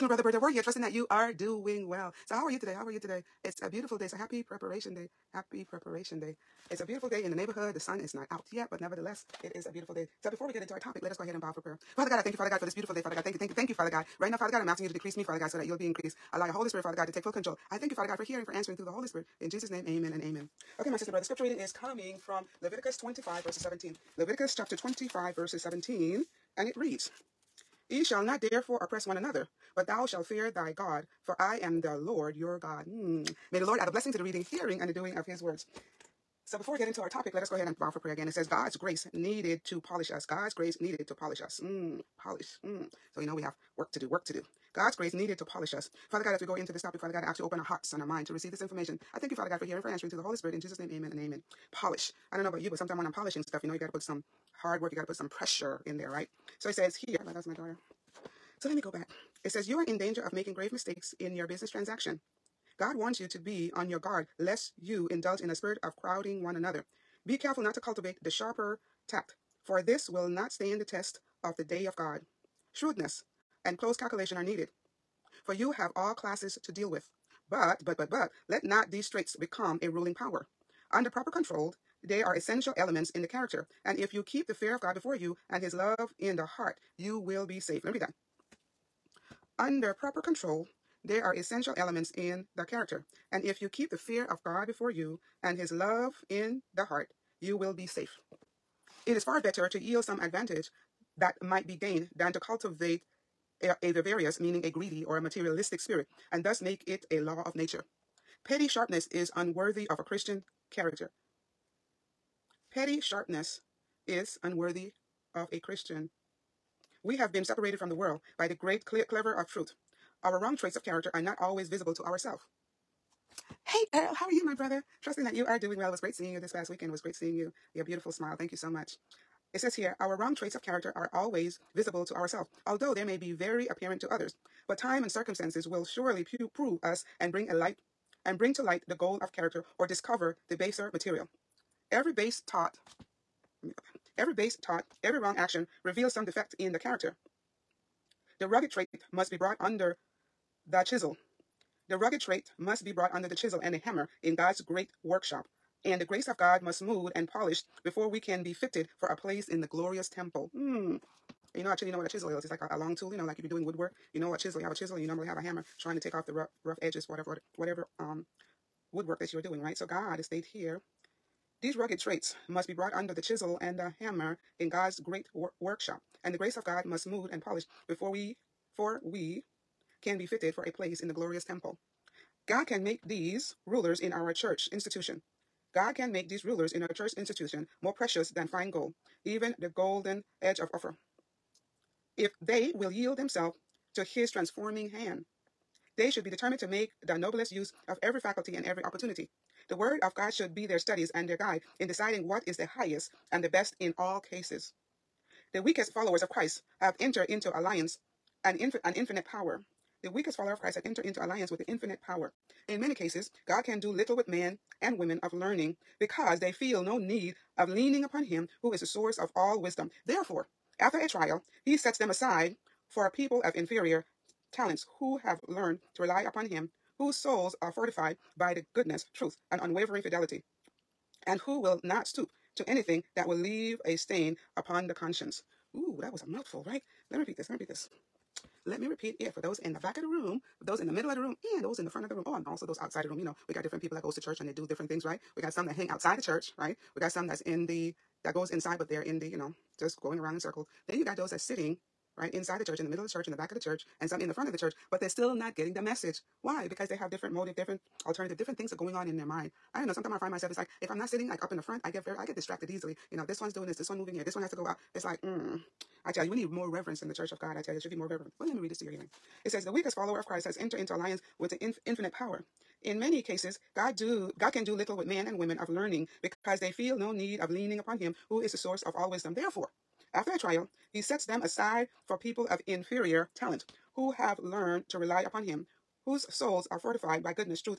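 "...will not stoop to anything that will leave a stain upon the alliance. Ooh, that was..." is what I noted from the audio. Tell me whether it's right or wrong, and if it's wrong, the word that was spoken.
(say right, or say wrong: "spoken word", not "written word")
wrong: "conscience", not "alliance".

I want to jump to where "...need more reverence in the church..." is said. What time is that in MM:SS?
04:26.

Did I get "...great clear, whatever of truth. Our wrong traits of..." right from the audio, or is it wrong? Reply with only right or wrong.
wrong.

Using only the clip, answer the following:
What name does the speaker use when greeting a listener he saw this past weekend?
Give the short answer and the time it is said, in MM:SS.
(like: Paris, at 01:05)
Earl, at 02:03.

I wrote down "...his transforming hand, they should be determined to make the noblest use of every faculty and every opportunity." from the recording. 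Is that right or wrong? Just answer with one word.
right.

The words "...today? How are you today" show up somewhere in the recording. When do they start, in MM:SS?
00:02.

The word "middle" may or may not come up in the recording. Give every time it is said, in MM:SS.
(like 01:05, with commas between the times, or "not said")
04:00, 04:12.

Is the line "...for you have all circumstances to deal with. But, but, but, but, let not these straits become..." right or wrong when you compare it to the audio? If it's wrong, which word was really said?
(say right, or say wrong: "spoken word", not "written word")
wrong: "classes", not "circumstances".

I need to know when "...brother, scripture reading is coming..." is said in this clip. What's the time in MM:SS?
00:21.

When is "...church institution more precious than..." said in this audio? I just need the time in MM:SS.
03:06.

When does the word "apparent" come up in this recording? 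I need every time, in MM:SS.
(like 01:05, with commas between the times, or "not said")
02:13.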